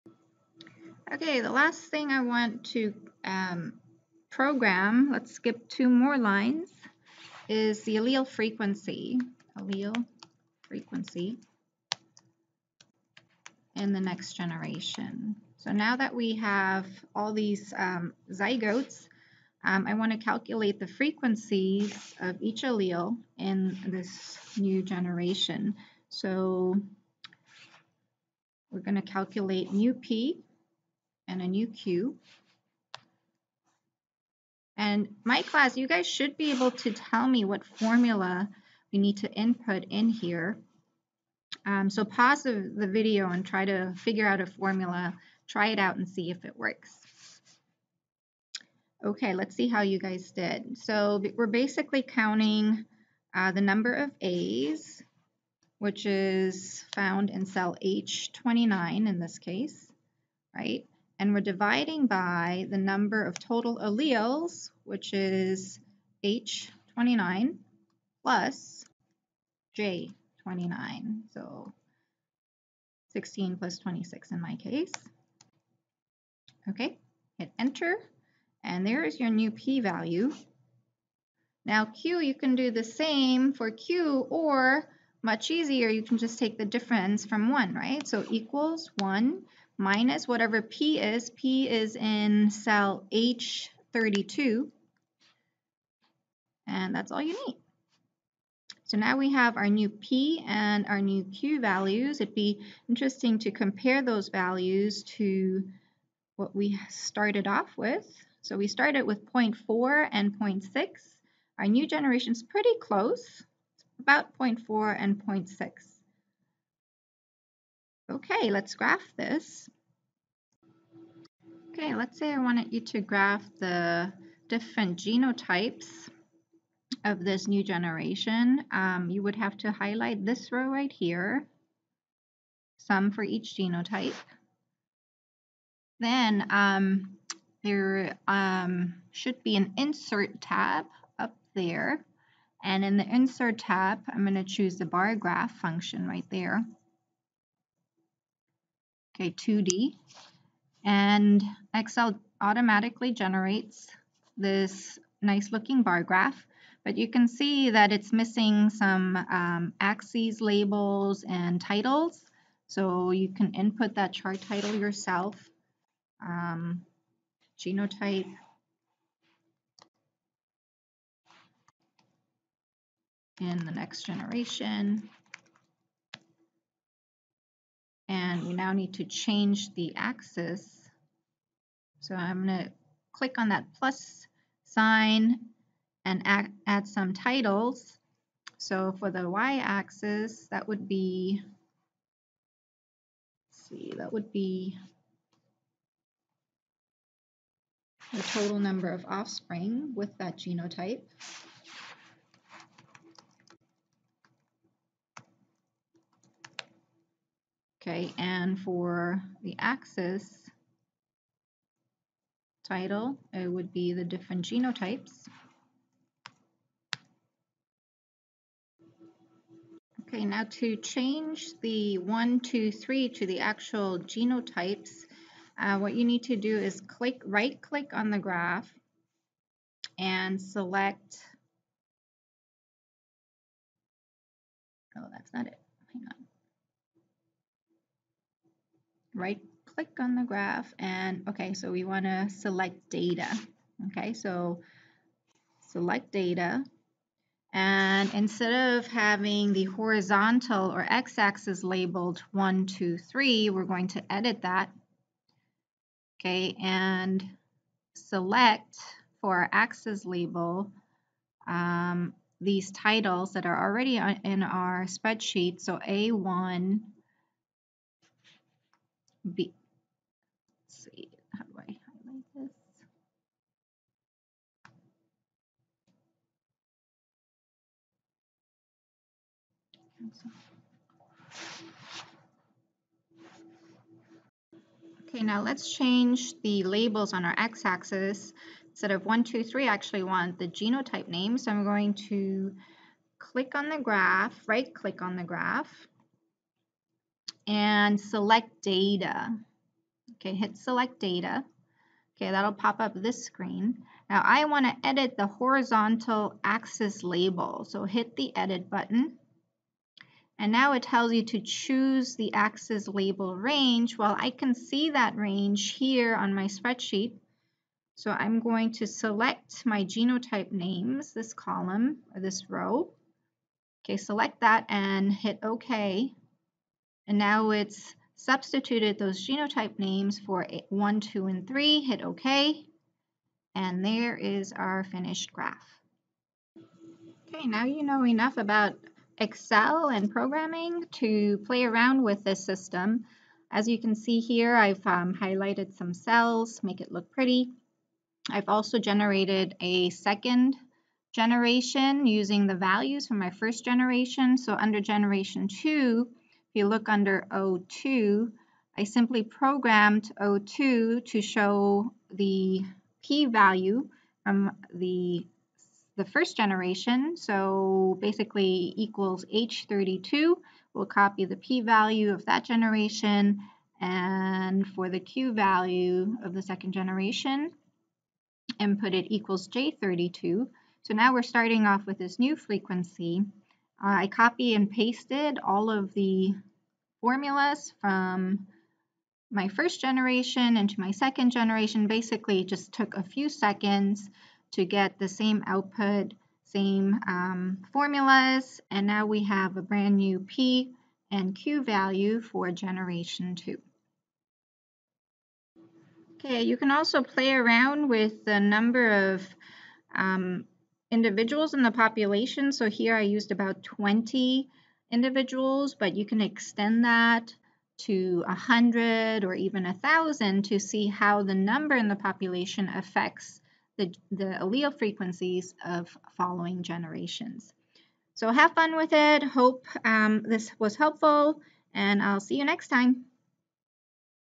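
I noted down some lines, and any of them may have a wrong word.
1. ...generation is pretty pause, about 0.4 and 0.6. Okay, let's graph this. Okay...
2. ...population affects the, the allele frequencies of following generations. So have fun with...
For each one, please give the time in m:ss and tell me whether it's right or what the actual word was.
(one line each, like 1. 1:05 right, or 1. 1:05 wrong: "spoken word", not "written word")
1. 1:51 wrong: "close", not "pause"
2. 7:01 right.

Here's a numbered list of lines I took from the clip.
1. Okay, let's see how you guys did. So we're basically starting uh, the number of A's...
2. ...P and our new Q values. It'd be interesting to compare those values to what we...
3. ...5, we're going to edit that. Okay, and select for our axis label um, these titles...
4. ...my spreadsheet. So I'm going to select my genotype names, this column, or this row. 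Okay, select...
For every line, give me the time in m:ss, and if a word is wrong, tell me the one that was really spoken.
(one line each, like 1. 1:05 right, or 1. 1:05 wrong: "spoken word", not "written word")
1. 0:49 wrong: "counting", not "starting"
2. 1:39 right
3. 4:12 wrong: "3", not "5"
4. 5:16 right.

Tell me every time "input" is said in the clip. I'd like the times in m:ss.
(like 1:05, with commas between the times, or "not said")
0:39, 2:43, 6:18.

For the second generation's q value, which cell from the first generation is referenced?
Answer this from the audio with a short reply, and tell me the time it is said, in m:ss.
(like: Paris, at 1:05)
J32, at 6:19.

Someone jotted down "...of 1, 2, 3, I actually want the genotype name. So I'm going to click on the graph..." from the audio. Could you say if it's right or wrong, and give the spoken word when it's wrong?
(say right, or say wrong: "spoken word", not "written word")
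right.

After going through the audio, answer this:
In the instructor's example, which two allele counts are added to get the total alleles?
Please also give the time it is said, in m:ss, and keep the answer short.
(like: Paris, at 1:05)
16 plus 26, at 1:13.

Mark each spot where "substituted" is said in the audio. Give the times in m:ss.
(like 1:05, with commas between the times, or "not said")
5:28.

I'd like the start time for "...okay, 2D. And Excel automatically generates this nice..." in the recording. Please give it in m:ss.
2:29.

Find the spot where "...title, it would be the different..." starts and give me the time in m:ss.
3:32.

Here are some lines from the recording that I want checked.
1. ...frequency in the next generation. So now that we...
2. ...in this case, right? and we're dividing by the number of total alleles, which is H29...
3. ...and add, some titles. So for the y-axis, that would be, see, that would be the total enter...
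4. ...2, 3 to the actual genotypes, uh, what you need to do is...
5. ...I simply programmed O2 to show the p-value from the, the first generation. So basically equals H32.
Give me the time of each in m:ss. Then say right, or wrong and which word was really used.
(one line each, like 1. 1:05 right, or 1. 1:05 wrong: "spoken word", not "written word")
1. 0:10 right
2. 0:59 right
3. 3:06 wrong: "number", not "enter"
4. 3:42 right
5. 5:58 right.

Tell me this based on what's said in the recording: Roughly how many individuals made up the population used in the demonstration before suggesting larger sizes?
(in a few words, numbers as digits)
20.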